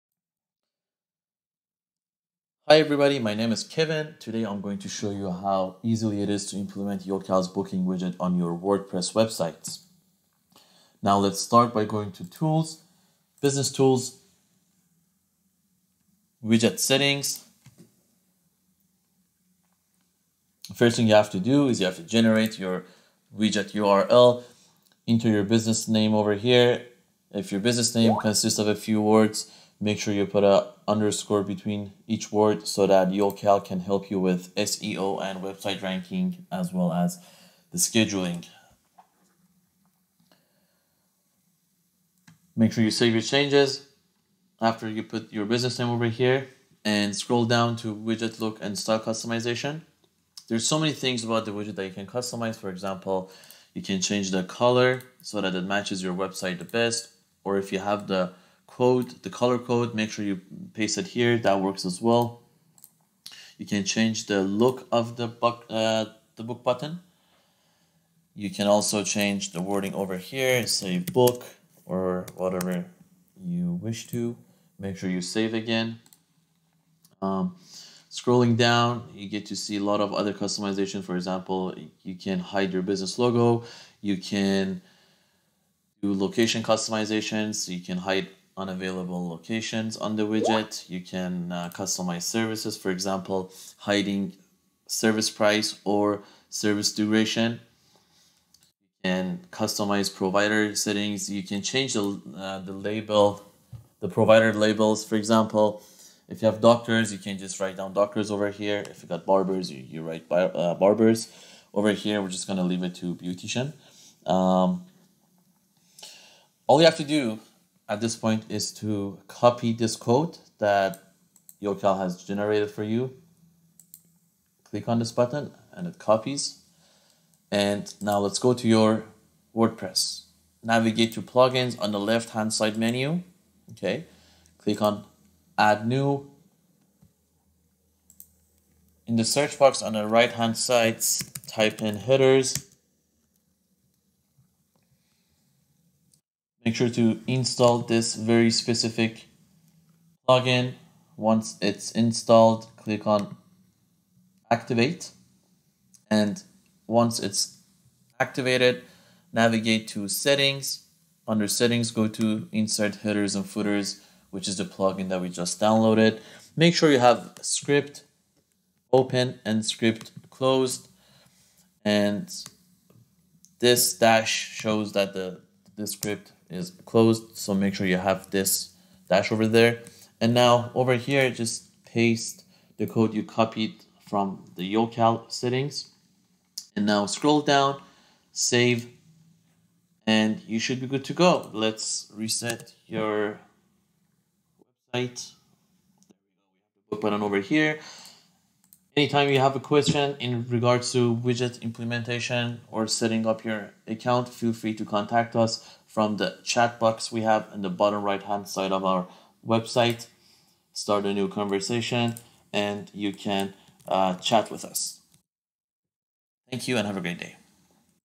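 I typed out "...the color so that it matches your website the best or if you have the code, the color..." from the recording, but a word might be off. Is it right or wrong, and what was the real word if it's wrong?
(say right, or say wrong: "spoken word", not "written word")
right.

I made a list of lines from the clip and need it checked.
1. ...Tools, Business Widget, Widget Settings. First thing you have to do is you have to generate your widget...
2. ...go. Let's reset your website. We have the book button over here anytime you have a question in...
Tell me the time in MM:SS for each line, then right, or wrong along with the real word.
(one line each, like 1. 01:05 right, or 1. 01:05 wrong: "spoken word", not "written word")
1. 00:12 wrong: "Tools", not "Widget"
2. 03:11 right.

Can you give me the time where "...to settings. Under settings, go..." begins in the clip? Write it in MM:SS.
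02:39.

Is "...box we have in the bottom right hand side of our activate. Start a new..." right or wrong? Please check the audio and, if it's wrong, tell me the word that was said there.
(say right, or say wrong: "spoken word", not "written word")
wrong: "website", not "activate".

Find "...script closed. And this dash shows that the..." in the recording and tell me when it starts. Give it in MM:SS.
02:49.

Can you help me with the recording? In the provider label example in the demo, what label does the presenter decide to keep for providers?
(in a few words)
beautician.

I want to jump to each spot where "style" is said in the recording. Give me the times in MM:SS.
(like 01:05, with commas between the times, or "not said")
00:48.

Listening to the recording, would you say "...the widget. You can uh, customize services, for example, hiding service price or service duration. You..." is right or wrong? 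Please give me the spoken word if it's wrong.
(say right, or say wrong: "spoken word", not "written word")
right.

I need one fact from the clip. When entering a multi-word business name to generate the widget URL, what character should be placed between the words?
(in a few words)
underscore.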